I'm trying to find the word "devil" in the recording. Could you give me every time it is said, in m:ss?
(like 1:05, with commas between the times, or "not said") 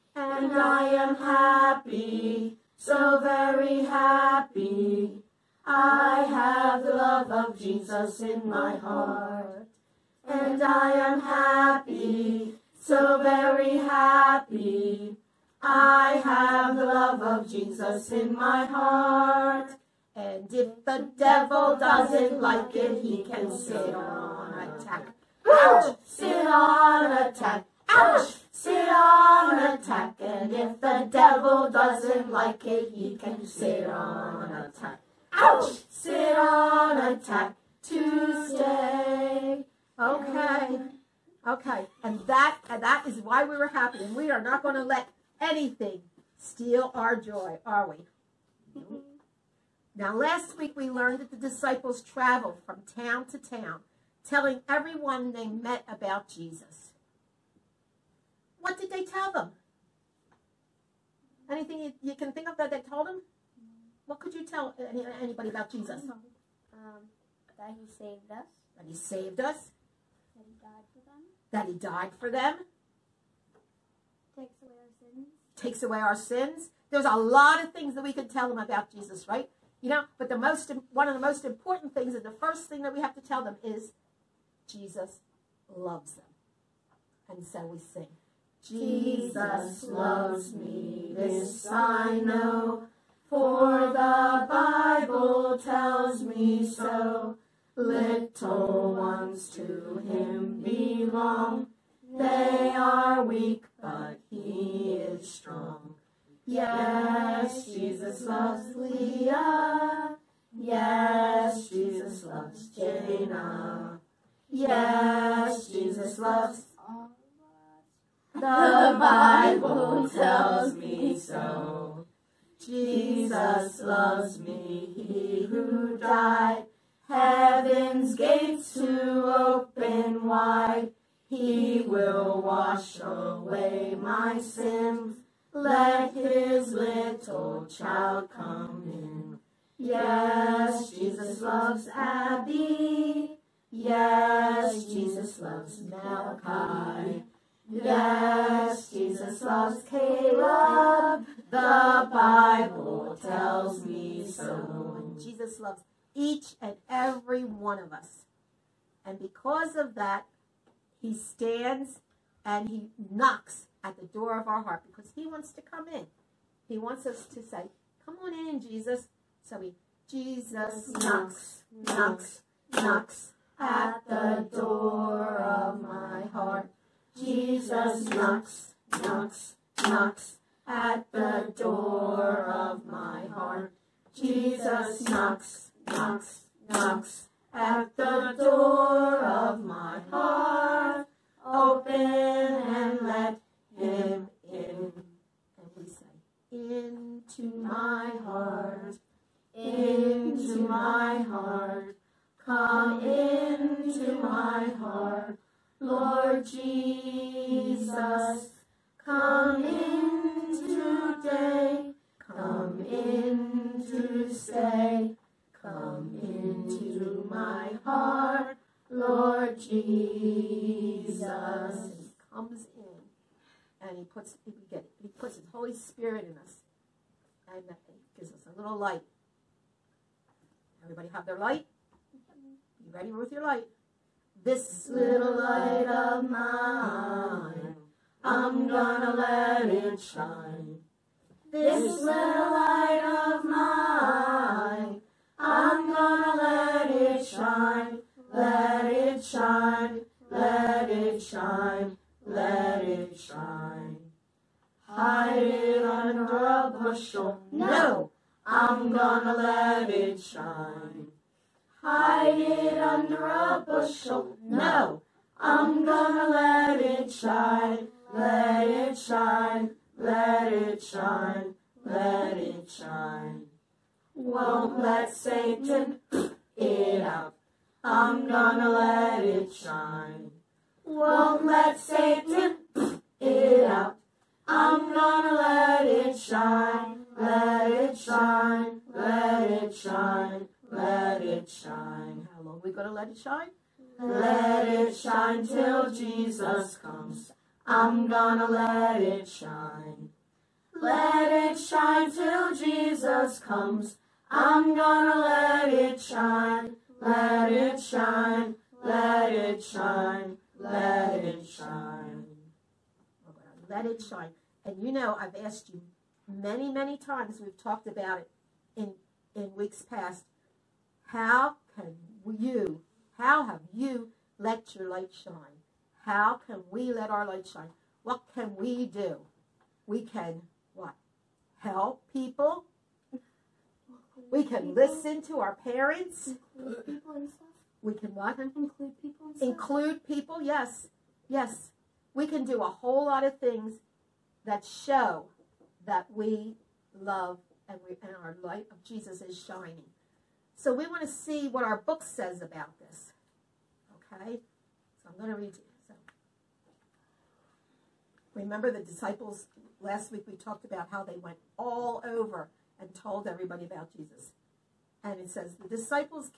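0:21, 0:31.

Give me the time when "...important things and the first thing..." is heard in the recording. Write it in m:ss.
1:21.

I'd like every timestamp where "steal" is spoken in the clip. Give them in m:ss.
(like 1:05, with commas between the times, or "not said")
0:46.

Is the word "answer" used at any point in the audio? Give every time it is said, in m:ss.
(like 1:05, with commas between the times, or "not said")
not said.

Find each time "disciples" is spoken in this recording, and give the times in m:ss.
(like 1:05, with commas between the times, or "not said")
0:51, 5:58, 6:05.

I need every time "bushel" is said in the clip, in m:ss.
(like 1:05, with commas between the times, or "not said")
4:16, 4:23.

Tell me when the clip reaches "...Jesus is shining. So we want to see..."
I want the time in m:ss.
5:48.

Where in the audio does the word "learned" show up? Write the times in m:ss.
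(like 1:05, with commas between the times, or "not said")
0:50.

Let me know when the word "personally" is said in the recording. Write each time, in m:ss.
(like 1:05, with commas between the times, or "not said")
not said.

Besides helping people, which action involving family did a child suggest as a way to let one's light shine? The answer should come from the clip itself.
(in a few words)
Listen to our parents.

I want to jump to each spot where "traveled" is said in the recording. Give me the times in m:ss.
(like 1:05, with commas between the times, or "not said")
0:52.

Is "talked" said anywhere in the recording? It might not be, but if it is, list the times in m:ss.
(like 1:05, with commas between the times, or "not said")
5:17, 6:00.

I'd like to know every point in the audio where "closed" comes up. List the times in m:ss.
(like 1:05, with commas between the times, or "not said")
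not said.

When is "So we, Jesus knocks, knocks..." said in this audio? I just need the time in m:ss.
2:49.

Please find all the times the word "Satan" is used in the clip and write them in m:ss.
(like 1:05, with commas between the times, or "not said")
4:35, 4:41.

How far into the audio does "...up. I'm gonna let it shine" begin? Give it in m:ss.
4:37.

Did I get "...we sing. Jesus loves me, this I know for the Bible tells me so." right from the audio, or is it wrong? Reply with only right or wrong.
right.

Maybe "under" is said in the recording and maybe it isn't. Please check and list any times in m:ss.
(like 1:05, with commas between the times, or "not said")
4:15, 4:22.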